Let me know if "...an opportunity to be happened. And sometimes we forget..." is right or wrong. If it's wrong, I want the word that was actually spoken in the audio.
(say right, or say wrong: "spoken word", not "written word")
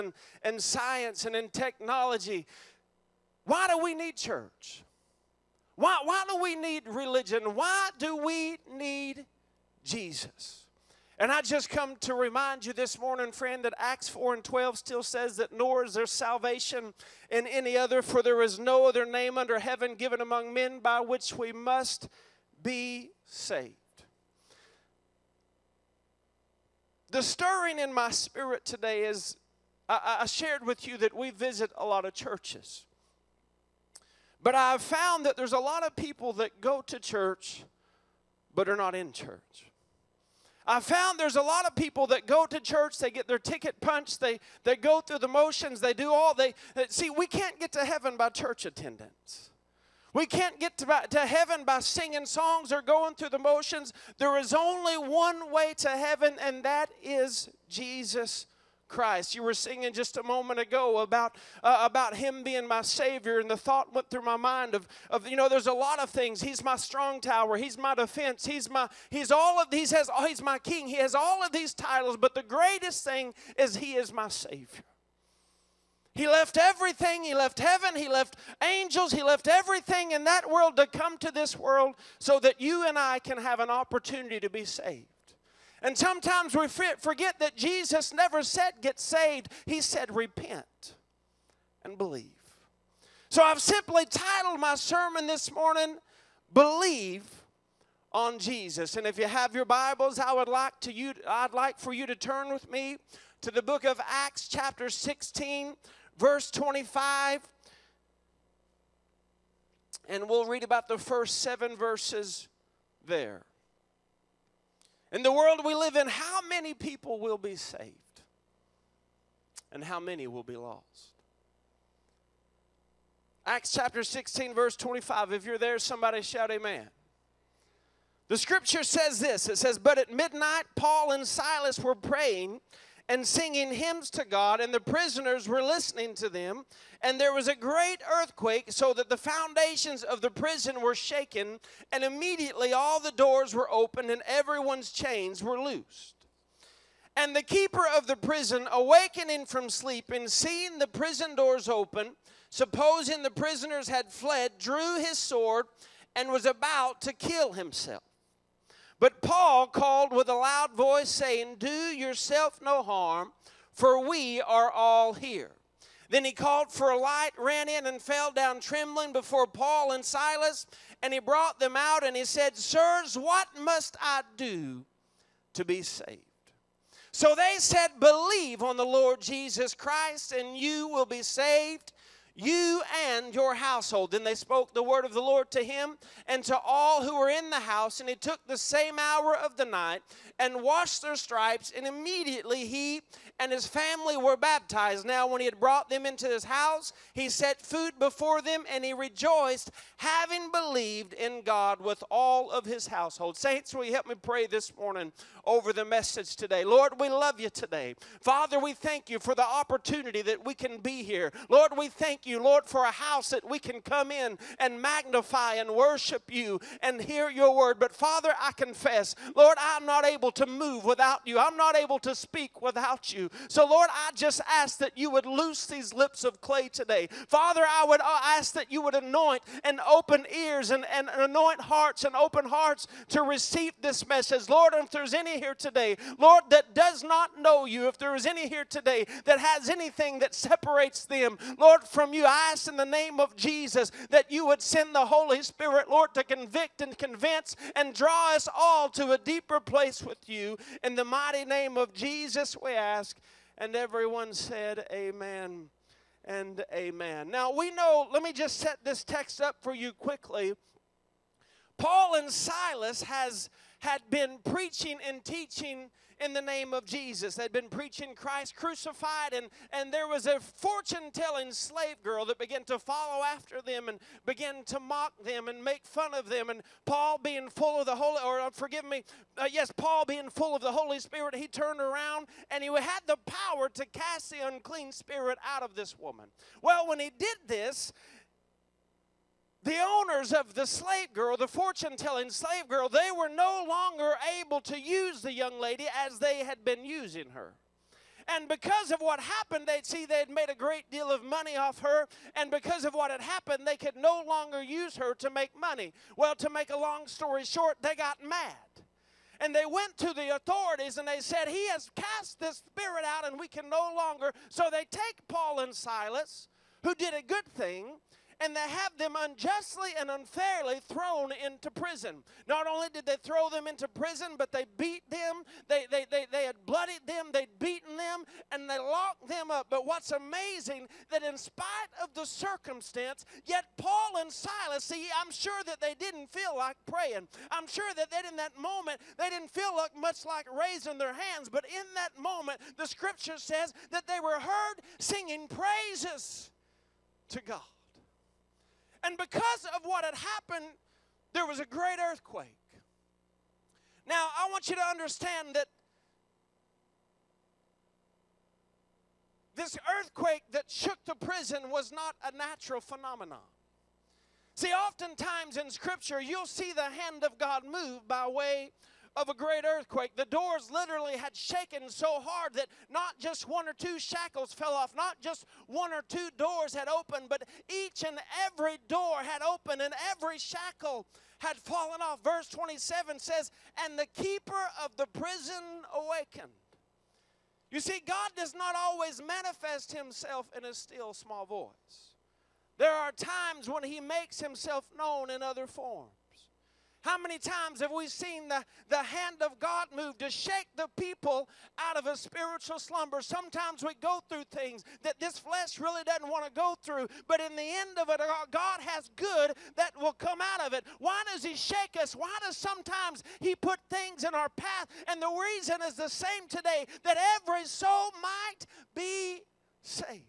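wrong: "saved", not "happened".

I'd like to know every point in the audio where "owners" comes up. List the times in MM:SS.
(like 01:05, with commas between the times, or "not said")
04:49.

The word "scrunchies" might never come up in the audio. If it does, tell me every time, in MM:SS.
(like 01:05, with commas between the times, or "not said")
not said.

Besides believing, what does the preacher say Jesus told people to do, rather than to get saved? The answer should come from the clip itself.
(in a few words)
Repent.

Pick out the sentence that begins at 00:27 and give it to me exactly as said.
The stirring in my spirit today is I, I shared with you that we visit a lot of churches.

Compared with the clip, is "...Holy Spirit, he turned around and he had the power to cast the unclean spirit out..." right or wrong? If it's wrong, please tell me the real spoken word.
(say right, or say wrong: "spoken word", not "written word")
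right.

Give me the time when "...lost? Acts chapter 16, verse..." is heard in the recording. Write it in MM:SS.
02:00.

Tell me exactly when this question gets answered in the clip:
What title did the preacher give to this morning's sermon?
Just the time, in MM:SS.
01:36.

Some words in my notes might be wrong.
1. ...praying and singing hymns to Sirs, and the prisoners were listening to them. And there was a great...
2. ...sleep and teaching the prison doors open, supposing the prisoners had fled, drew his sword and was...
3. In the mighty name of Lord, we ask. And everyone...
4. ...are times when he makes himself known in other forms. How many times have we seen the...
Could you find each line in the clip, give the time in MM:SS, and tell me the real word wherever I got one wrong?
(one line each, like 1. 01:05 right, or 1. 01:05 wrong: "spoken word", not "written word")
1. 02:11 wrong: "God", not "Sirs"
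2. 02:29 wrong: "seeing", not "teaching"
3. 04:10 wrong: "Jesus", not "Lord"
4. 06:32 right.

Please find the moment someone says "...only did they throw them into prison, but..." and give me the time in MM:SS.
05:22.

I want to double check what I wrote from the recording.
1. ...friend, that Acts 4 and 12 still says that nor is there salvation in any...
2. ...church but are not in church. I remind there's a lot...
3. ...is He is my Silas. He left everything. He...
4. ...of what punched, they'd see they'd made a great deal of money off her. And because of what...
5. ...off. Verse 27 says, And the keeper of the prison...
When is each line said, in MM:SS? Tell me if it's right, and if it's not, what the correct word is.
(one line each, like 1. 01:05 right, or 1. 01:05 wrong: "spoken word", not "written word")
1. 00:13 right
2. 00:36 wrong: "found", not "remind"
3. 01:13 wrong: "Savior", not "Silas"
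4. 04:58 wrong: "happened", not "punched"
5. 06:22 right.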